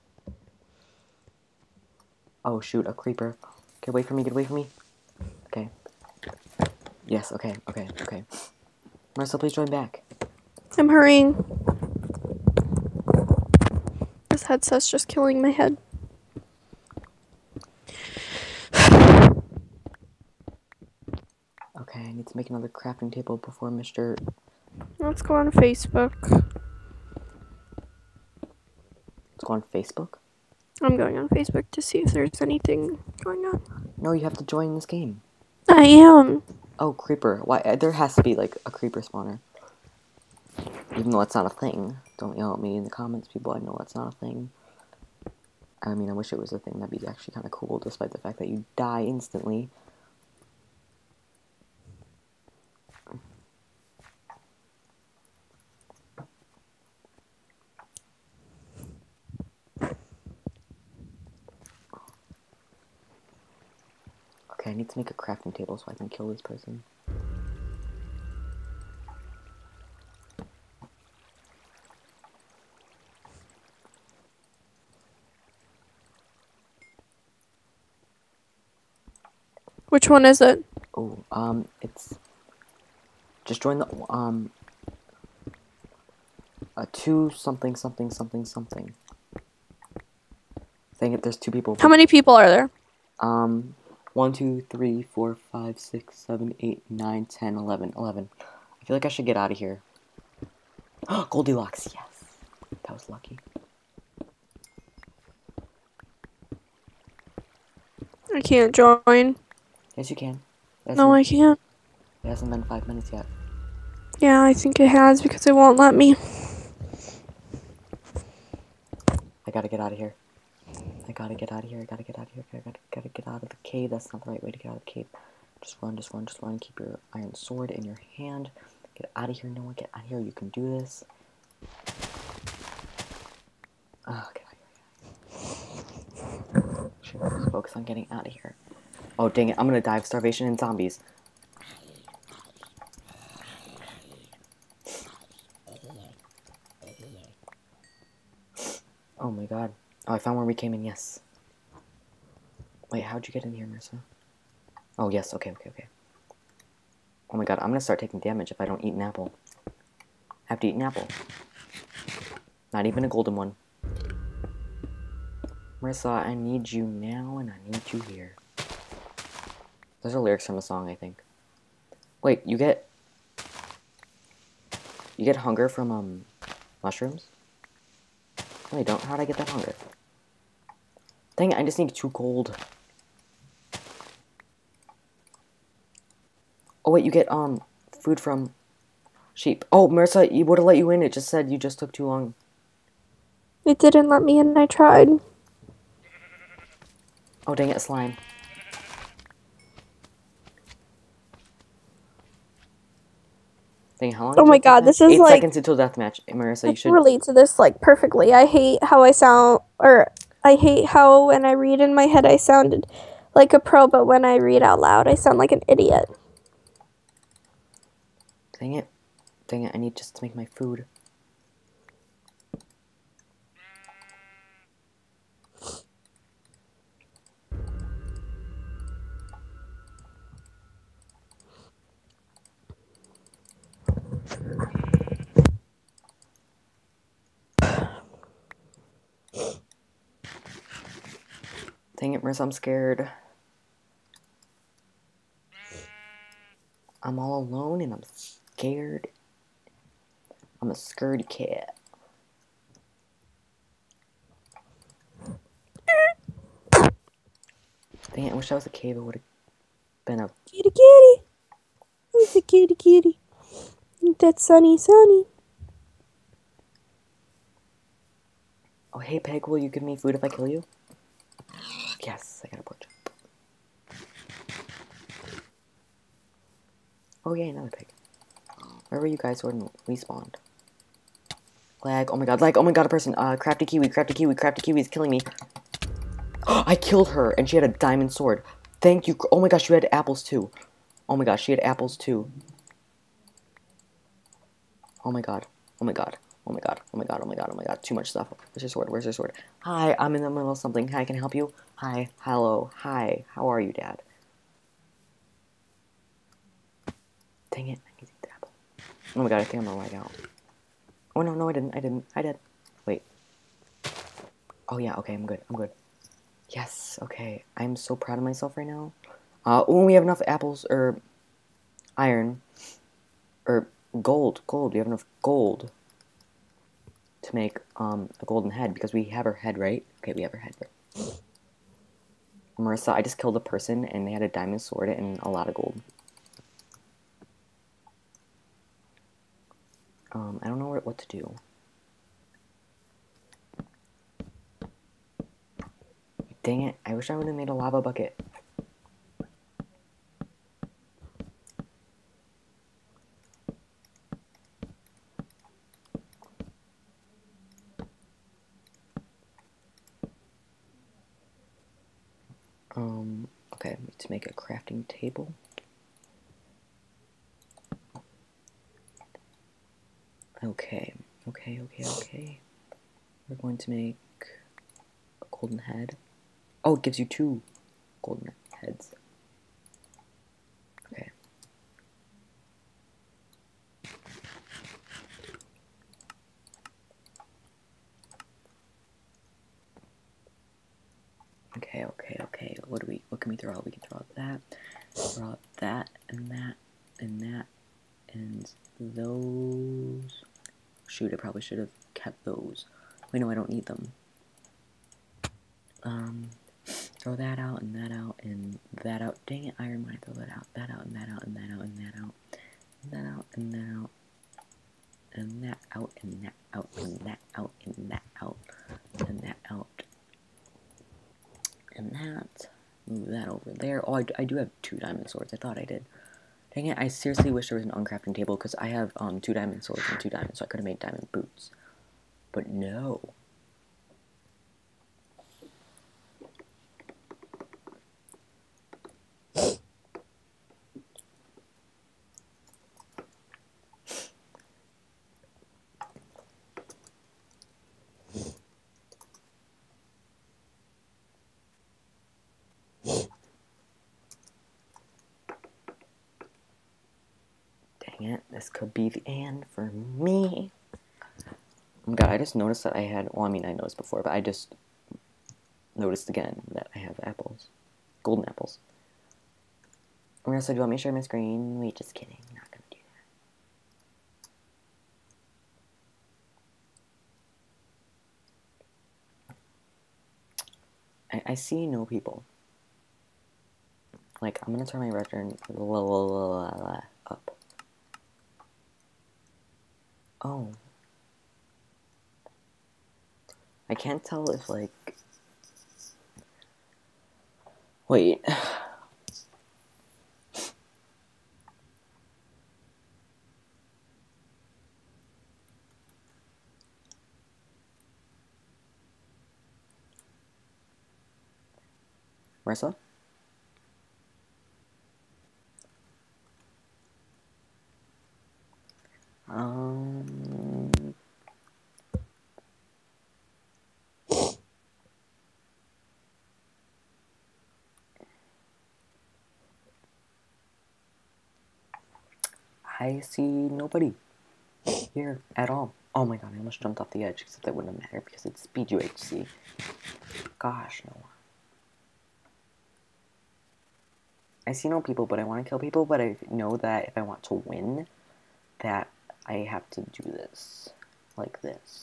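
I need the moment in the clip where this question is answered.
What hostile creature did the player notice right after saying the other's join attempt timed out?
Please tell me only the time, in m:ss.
3:17.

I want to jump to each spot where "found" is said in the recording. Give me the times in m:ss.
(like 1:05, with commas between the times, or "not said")
2:30.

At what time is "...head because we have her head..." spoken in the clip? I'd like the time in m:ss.
5:28.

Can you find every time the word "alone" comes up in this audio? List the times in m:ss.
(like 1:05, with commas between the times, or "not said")
4:07.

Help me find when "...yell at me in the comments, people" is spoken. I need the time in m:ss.
0:42.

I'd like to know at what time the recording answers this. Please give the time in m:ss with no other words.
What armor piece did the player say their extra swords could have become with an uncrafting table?
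7:10.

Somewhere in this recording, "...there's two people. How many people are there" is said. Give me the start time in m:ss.
1:31.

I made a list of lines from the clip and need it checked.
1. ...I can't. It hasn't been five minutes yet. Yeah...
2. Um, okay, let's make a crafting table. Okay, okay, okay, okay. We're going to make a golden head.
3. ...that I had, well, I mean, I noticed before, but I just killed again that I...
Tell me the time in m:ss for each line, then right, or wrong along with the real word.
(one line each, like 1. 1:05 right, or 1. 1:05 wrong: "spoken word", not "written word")
1. 1:51 right
2. 6:02 right
3. 7:42 wrong: "noticed", not "killed".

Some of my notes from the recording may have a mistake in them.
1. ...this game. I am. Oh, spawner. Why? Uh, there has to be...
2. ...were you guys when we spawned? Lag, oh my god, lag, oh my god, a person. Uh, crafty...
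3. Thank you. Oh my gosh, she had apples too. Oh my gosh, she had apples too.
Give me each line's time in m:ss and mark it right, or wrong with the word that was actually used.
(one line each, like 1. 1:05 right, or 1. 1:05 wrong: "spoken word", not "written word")
1. 0:34 wrong: "creeper", not "spawner"
2. 4:38 right
3. 4:48 right.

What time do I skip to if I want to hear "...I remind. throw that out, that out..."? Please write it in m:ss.
6:49.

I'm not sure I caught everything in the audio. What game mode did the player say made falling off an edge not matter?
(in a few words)
Speed UHC.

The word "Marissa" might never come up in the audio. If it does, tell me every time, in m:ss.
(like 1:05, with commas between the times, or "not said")
2:33, 2:45, 3:09, 3:26, 5:32, 8:32.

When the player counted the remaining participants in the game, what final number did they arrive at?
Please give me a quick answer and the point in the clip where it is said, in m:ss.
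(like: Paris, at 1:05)
11, at 1:37.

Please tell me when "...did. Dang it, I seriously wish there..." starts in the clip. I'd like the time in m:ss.
7:05.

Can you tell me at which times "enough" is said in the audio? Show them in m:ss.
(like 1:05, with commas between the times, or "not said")
5:20, 5:24.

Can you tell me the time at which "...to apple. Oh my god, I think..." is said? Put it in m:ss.
5:08.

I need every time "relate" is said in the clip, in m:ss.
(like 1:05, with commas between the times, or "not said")
3:26.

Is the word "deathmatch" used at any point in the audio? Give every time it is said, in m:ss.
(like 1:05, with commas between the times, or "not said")
3:25.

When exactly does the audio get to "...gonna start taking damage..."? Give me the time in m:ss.
2:37.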